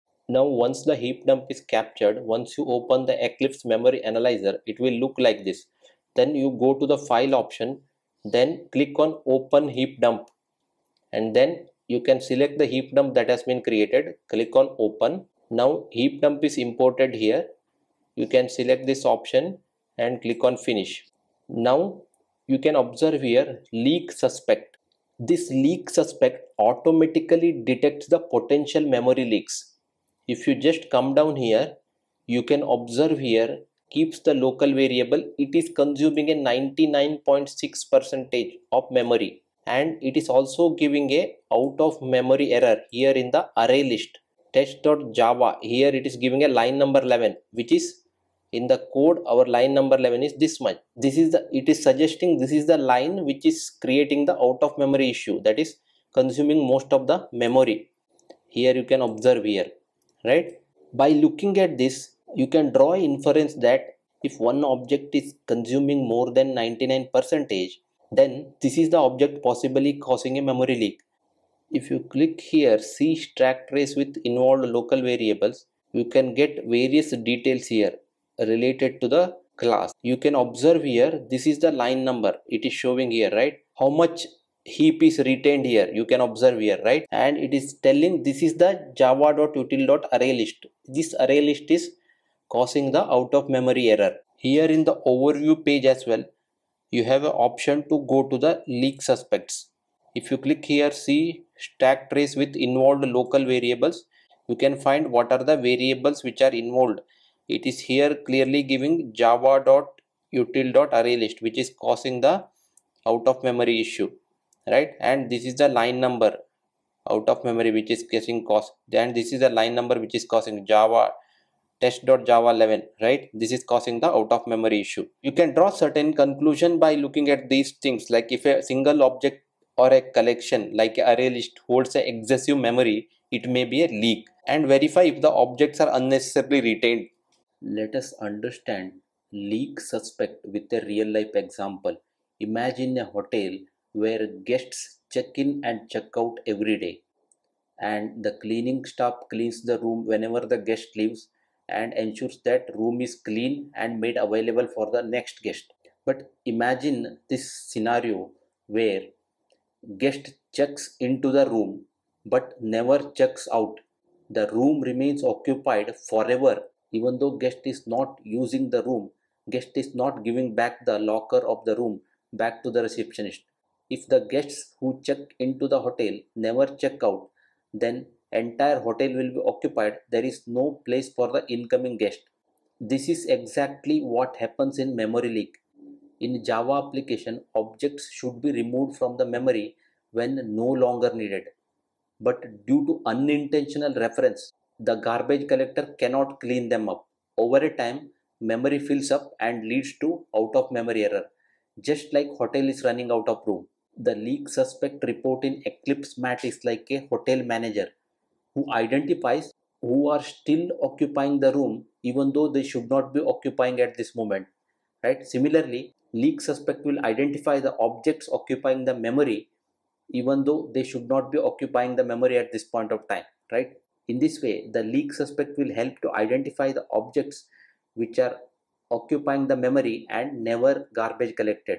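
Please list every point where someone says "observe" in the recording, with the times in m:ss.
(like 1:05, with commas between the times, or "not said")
0:22, 0:32, 0:59, 1:20, 1:26.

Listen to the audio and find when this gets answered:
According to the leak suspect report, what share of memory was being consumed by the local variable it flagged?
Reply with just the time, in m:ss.
0:36.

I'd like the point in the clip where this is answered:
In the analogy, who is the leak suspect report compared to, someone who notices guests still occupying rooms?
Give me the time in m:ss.
3:27.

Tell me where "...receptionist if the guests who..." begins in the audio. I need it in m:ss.
2:52.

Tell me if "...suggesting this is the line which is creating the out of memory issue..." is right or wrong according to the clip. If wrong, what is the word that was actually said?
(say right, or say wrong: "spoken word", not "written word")
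right.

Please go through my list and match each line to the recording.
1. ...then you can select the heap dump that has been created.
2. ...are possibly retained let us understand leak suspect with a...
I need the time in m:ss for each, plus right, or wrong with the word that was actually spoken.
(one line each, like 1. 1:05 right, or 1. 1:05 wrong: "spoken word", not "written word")
1. 0:11 right
2. 2:15 wrong: "unnecessarily", not "possibly".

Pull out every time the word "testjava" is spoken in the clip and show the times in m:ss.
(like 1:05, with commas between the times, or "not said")
0:44, 2:01.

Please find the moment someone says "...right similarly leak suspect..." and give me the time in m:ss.
3:35.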